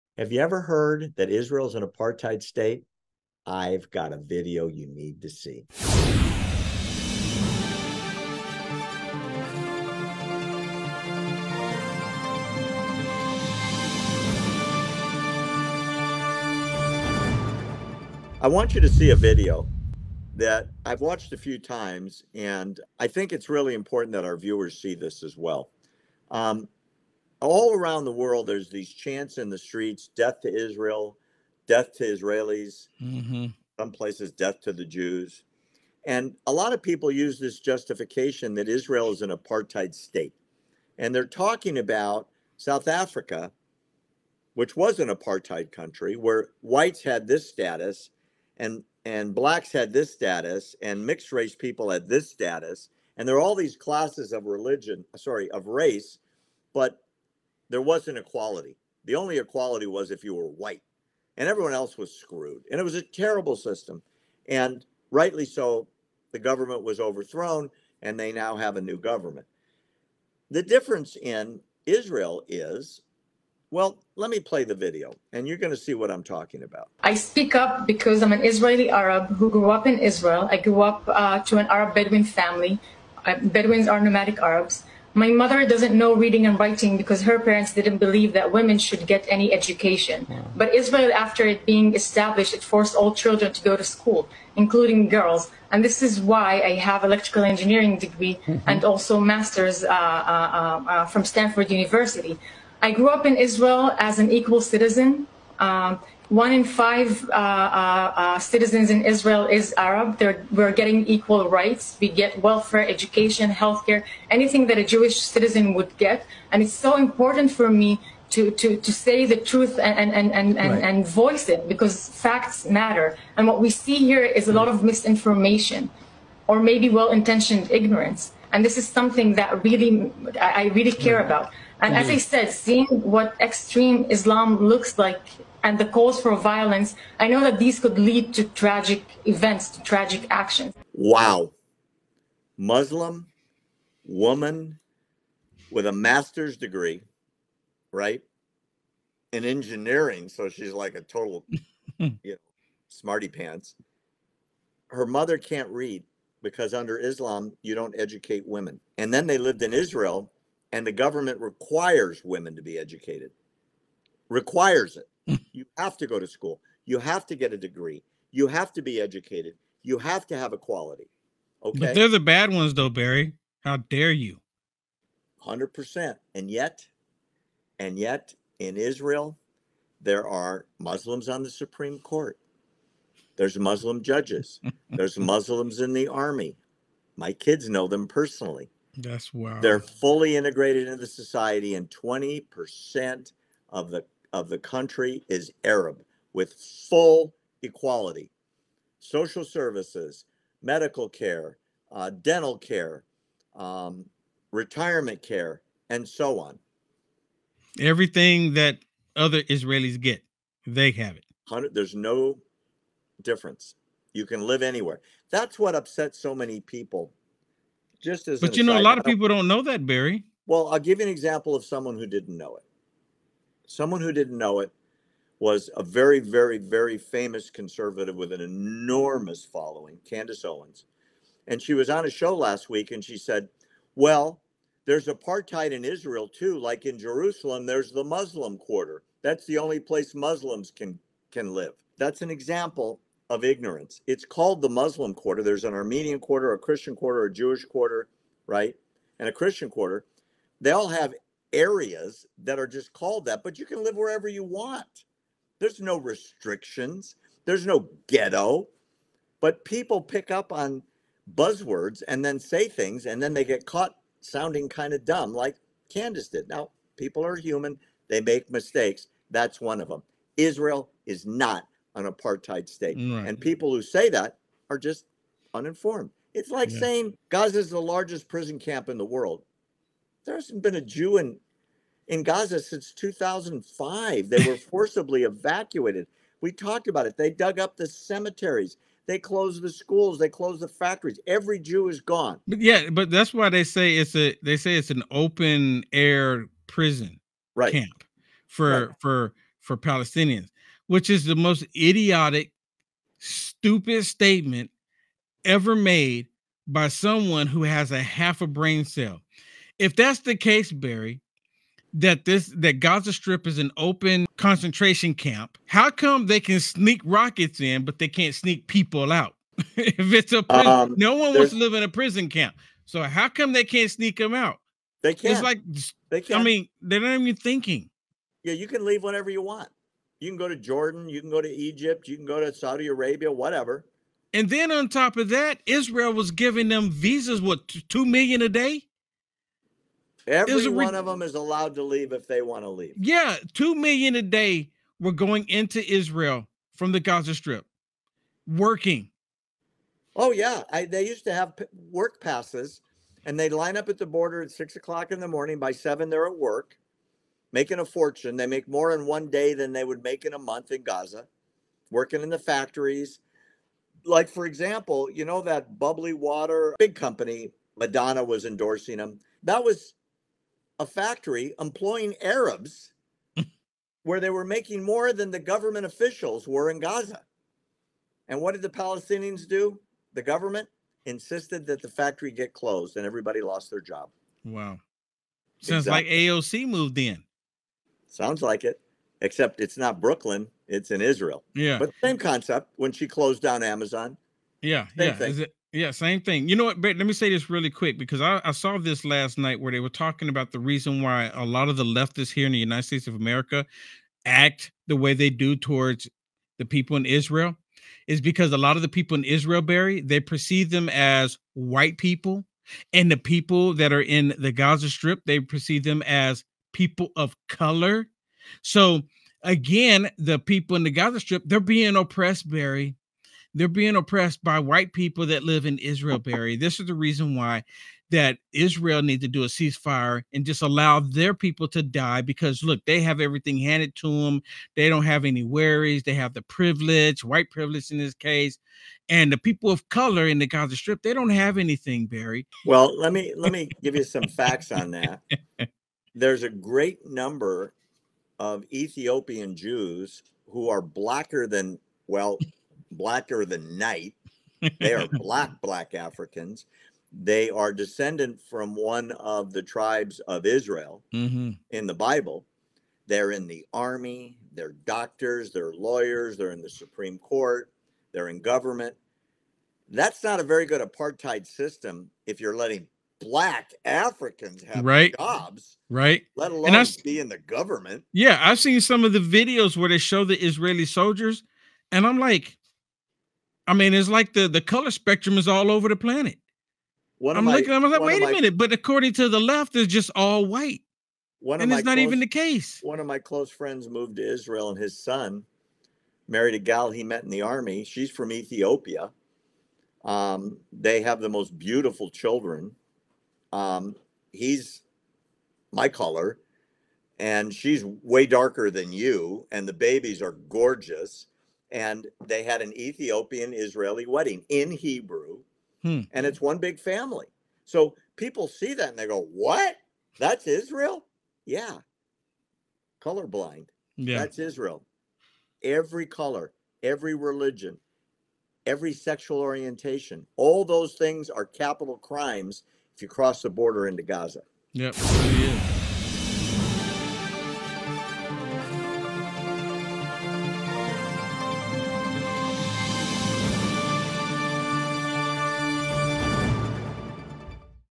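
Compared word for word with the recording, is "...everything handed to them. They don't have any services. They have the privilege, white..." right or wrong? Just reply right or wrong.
wrong.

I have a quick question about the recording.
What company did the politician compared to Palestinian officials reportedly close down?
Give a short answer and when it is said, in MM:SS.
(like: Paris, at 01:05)
Amazon, at 06:33.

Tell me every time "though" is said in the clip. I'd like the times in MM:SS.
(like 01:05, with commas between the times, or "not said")
02:52.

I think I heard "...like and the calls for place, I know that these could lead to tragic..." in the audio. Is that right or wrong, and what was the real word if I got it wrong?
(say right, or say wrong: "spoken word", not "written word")
wrong: "violence", not "place".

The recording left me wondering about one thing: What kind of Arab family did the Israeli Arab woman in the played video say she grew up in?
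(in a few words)
Bedouin.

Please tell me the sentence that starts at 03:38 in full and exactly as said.
Just as but you know, aside, a lot of people don't know that, Barry.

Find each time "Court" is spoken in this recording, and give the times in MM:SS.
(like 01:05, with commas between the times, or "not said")
03:01, 07:47.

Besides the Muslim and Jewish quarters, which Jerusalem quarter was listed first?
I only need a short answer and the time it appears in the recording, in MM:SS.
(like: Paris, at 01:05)
Armenian quarter, at 04:05.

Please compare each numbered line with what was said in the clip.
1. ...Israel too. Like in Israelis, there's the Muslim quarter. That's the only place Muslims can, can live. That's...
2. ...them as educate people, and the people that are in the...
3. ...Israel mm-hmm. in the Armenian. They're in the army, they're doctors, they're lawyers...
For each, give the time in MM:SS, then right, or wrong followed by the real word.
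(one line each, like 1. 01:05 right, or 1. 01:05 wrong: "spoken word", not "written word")
1. 03:55 wrong: "Jerusalem", not "Israelis"
2. 06:50 wrong: "white", not "educate"
3. 07:40 wrong: "Bible", not "Armenian".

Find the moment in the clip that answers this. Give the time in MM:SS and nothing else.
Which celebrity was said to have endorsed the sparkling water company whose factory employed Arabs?
06:07.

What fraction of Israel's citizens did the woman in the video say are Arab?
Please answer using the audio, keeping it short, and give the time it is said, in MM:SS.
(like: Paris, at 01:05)
1 in 5, at 01:46.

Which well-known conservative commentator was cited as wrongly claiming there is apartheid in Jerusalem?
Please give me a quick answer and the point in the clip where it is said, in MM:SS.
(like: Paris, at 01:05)
Candace Owens, at 03:50.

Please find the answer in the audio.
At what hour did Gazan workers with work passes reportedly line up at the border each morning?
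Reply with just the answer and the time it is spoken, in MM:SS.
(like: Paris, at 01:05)
6 o'clock, at 05:54.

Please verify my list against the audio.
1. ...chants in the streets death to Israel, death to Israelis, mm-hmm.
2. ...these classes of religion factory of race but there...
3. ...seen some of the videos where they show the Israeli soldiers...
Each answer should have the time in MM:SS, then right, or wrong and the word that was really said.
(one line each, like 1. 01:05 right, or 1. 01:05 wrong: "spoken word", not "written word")
1. 00:28 right
2. 00:53 wrong: "sorry", not "factory"
3. 07:58 right.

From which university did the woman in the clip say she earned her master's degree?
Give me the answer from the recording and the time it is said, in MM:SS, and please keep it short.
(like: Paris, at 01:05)
Stanford University, at 01:41.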